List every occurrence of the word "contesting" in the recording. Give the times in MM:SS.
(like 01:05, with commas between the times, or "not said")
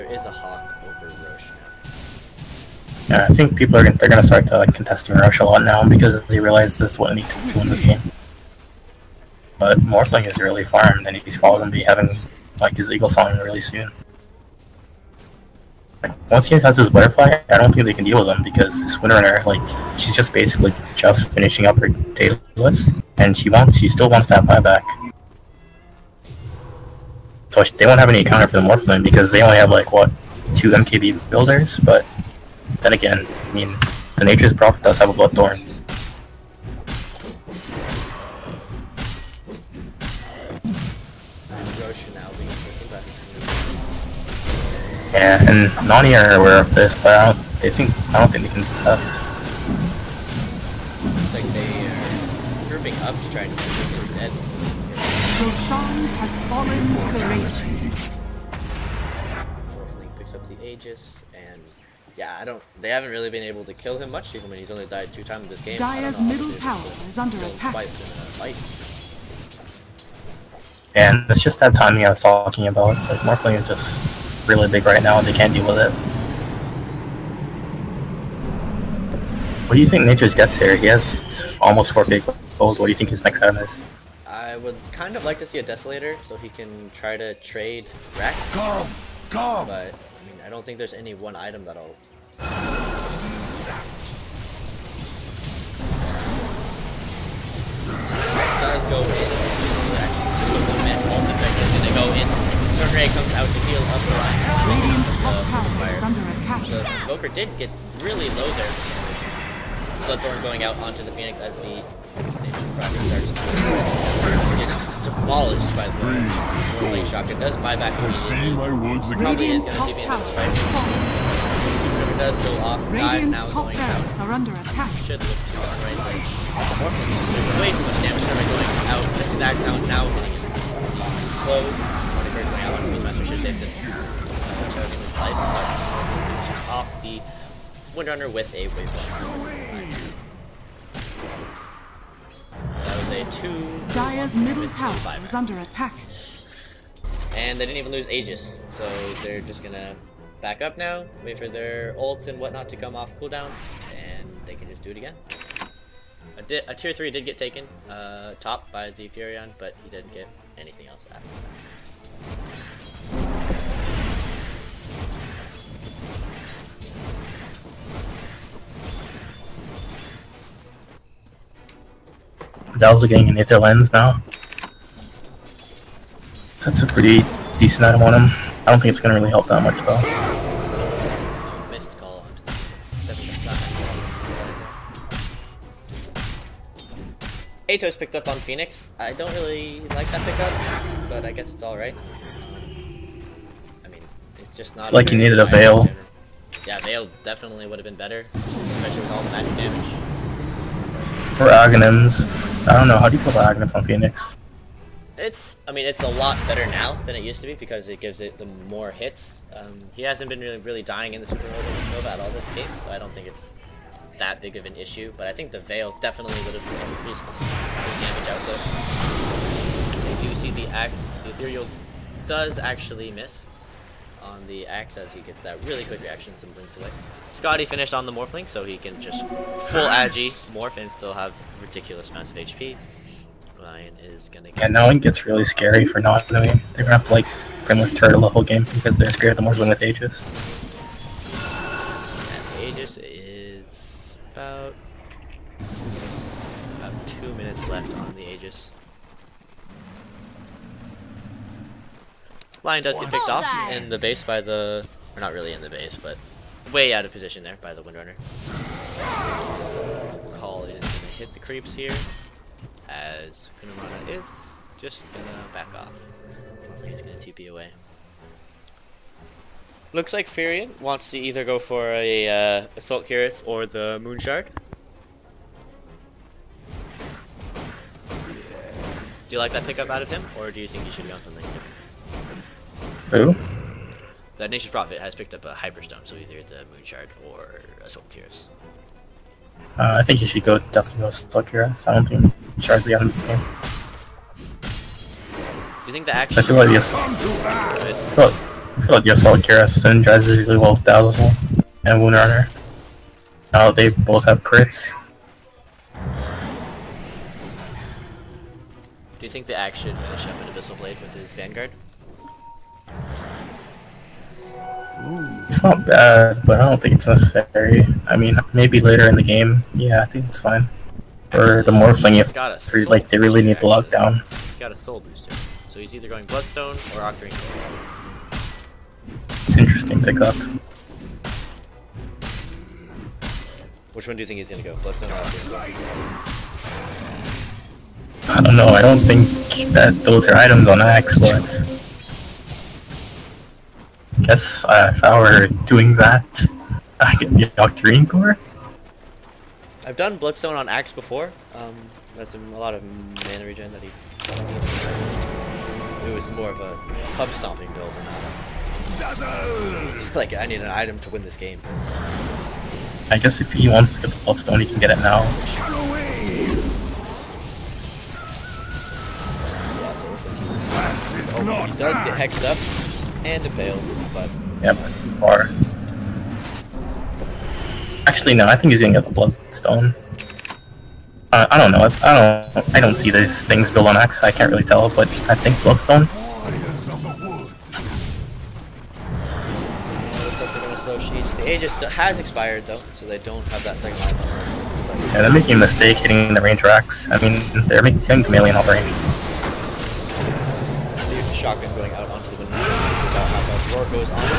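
00:04.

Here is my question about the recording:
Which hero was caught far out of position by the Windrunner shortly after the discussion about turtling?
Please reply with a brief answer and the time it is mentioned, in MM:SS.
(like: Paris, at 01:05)
Lion, at 04:12.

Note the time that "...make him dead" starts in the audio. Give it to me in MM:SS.
00:53.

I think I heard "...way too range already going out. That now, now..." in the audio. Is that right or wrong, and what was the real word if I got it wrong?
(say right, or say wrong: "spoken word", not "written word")
wrong: "damage", not "range".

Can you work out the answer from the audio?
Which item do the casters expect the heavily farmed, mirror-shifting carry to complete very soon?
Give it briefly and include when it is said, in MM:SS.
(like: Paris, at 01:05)
Eaglesong, at 00:12.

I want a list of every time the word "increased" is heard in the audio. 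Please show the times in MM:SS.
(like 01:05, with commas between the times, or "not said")
03:36.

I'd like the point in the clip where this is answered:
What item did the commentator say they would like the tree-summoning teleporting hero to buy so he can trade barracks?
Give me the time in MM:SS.
01:25.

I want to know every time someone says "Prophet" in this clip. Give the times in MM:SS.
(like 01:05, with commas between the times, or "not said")
00:34, 04:44.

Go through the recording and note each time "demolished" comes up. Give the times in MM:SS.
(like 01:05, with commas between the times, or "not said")
01:55.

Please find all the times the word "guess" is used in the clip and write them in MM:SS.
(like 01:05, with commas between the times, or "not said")
03:11, 05:44, 06:03.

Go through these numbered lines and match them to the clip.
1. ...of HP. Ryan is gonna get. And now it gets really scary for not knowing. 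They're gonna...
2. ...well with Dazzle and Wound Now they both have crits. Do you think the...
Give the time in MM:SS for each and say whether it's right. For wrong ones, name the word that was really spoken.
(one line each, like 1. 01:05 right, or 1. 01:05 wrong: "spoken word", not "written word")
1. 03:52 right
2. 05:00 right.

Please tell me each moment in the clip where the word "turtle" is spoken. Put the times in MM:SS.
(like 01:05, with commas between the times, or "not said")
03:57.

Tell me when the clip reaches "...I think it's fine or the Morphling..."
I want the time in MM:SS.
05:20.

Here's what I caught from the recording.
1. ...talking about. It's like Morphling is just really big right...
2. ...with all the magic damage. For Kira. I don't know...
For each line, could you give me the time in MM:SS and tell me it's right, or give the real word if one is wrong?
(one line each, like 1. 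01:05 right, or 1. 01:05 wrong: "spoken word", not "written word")
1. 01:12 right
2. 03:19 wrong: "Aghanims", not "Kira".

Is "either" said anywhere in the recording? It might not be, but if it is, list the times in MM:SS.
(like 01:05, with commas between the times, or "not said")
04:31, 04:46, 05:25.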